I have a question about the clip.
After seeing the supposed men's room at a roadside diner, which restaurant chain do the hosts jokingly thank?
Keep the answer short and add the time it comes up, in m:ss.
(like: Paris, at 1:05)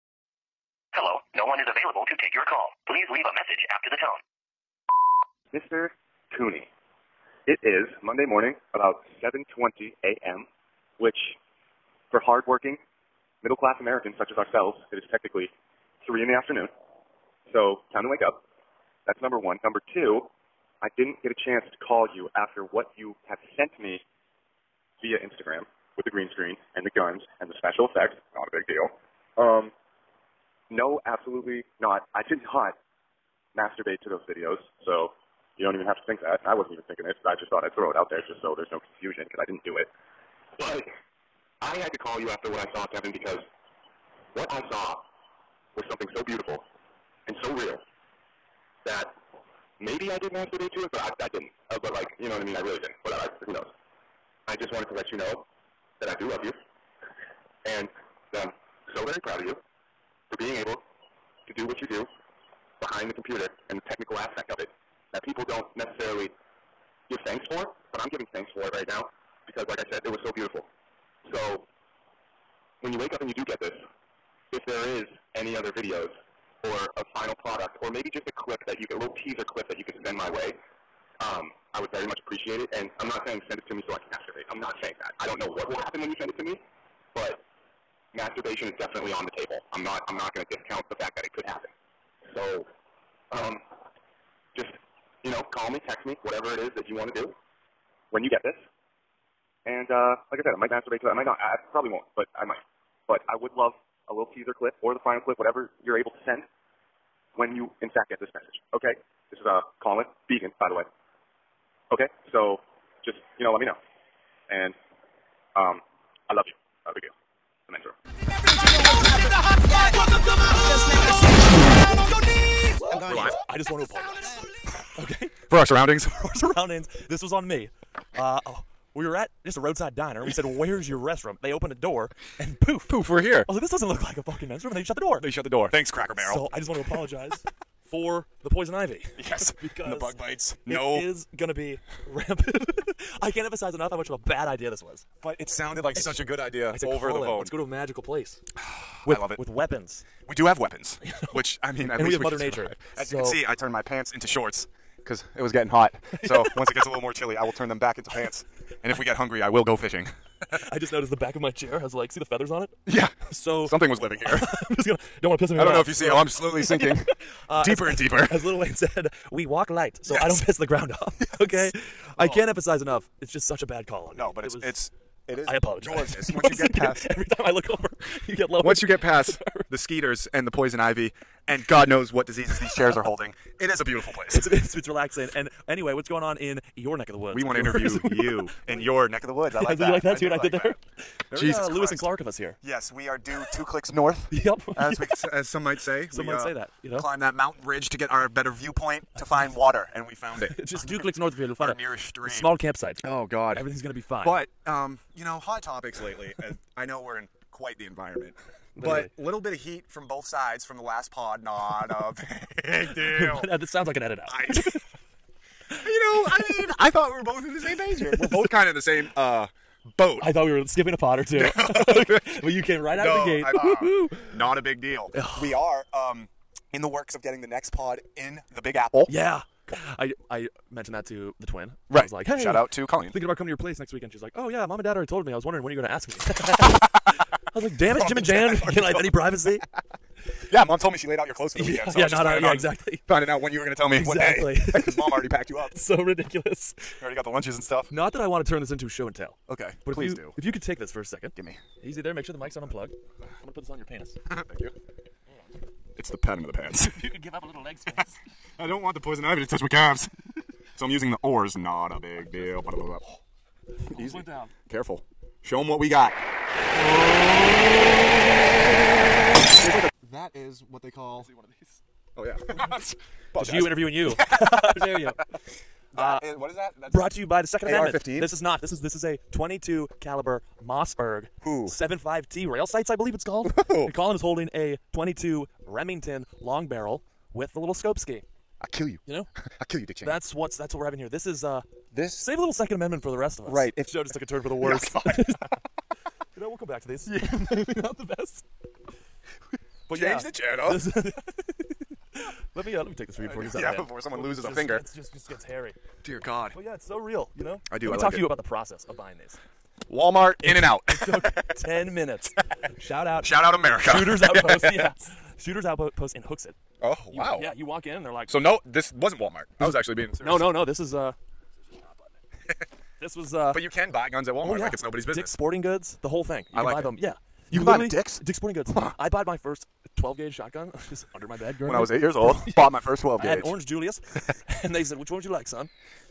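Cracker Barrel, at 2:15.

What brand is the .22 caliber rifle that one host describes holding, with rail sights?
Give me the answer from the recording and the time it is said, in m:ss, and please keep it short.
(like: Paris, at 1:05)
Mossberg, at 4:40.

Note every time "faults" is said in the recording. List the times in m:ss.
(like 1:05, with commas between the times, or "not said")
not said.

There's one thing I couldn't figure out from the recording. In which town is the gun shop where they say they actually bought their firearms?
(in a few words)
Hooksett.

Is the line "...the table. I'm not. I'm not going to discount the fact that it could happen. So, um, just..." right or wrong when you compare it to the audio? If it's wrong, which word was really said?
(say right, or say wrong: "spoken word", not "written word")
right.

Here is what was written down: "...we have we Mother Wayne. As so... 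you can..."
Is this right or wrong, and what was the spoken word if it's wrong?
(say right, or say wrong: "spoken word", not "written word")
wrong: "Nature", not "Wayne".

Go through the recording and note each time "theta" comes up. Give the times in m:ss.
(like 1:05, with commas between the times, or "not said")
not said.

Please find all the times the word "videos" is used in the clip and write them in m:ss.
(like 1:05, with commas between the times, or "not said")
0:34, 1:15.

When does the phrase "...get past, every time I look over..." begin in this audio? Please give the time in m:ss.
2:56.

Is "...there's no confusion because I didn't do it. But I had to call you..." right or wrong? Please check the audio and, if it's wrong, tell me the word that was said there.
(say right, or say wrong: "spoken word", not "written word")
right.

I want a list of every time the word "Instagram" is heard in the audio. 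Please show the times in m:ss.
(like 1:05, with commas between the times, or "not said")
0:25.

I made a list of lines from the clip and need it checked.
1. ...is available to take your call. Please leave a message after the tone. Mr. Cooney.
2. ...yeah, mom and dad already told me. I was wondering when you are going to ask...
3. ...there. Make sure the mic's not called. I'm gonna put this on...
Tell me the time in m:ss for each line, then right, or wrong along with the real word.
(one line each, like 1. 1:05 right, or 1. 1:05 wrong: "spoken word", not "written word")
1. 0:01 right
2. 3:54 right
3. 4:12 wrong: "unplugged", not "called".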